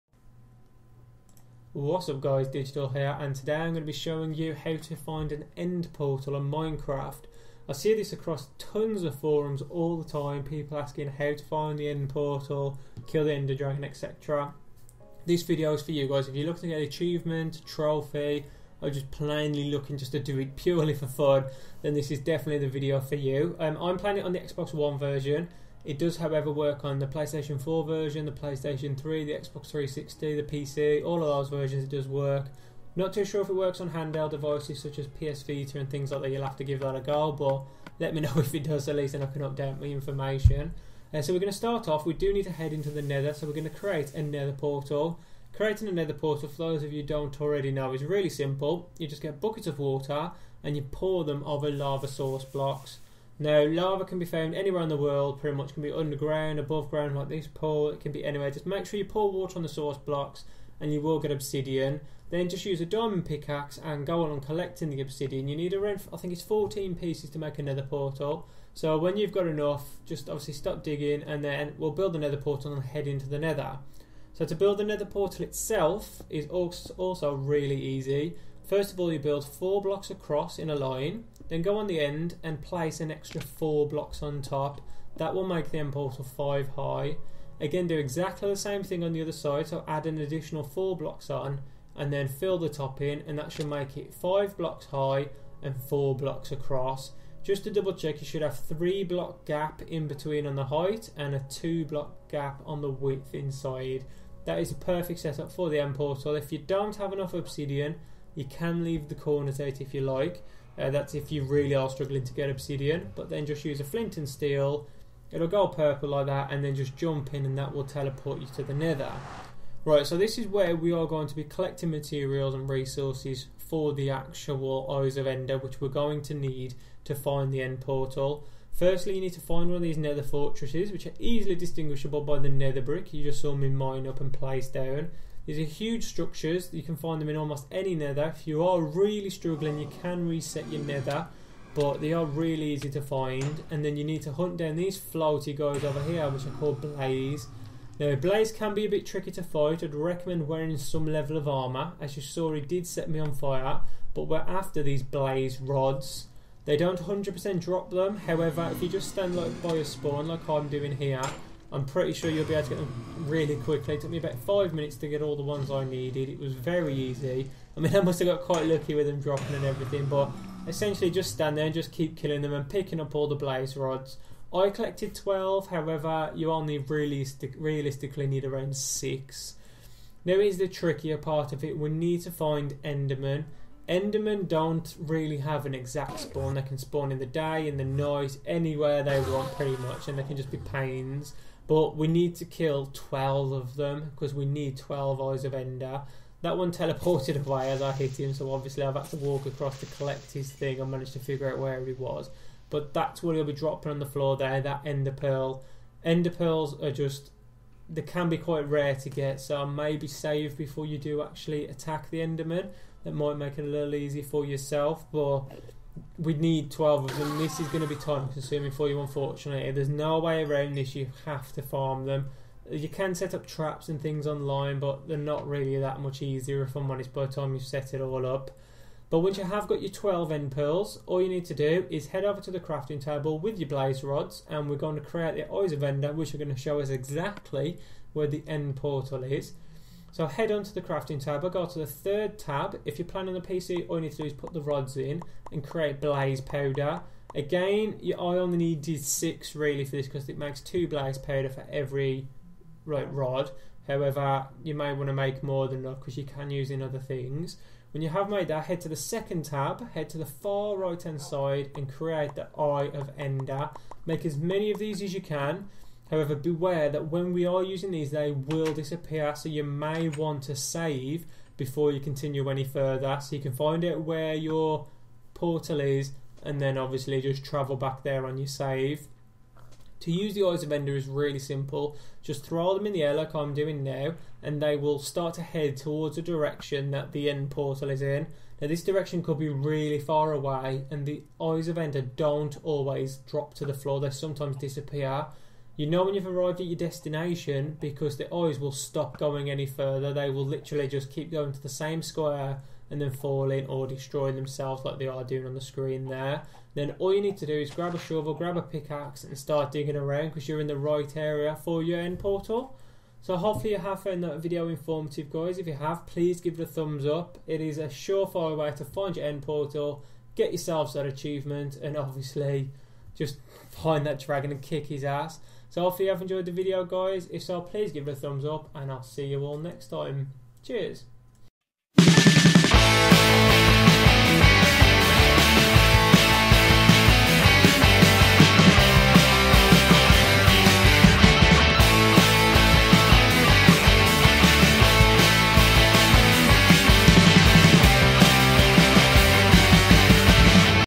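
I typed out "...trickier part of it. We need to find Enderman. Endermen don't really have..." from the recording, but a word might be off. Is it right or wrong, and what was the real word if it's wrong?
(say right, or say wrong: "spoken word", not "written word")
right.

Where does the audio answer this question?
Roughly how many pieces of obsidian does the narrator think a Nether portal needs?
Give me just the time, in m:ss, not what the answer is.
1:06.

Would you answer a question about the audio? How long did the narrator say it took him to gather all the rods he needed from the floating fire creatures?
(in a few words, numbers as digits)
about five minutes.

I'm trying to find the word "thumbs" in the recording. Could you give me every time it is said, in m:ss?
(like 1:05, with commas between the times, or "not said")
5:16, 5:28.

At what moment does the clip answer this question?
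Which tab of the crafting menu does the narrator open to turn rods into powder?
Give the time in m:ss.
4:01.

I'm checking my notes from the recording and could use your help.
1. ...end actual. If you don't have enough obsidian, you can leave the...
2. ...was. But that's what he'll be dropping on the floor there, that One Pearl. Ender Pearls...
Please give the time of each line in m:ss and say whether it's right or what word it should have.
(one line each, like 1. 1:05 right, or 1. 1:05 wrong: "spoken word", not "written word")
1. 1:45 wrong: "portal", not "actual"
2. 3:21 wrong: "Ender", not "One".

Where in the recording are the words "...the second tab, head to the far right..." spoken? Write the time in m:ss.
4:18.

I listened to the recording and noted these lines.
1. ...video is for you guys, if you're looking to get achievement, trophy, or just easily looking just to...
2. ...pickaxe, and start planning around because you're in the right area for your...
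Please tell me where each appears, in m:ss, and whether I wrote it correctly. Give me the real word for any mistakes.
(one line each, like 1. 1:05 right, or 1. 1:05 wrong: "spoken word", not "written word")
1. 0:15 wrong: "plainly", not "easily"
2. 5:08 wrong: "digging", not "planning".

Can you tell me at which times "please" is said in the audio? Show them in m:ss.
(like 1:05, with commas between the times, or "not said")
5:16, 5:27.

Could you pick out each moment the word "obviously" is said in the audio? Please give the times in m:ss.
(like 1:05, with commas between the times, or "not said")
1:10, 3:18, 4:36, 5:21.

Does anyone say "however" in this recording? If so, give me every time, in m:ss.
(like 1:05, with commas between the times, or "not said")
0:26, 2:38, 2:55, 4:13, 4:26.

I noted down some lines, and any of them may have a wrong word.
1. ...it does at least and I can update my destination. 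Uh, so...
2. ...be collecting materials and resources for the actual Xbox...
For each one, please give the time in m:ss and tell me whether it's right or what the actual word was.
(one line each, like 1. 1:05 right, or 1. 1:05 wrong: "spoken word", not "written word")
1. 0:38 wrong: "information", not "destination"
2. 2:01 wrong: "Eyes", not "Xbox".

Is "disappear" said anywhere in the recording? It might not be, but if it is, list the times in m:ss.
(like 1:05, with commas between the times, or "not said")
4:28, 4:54.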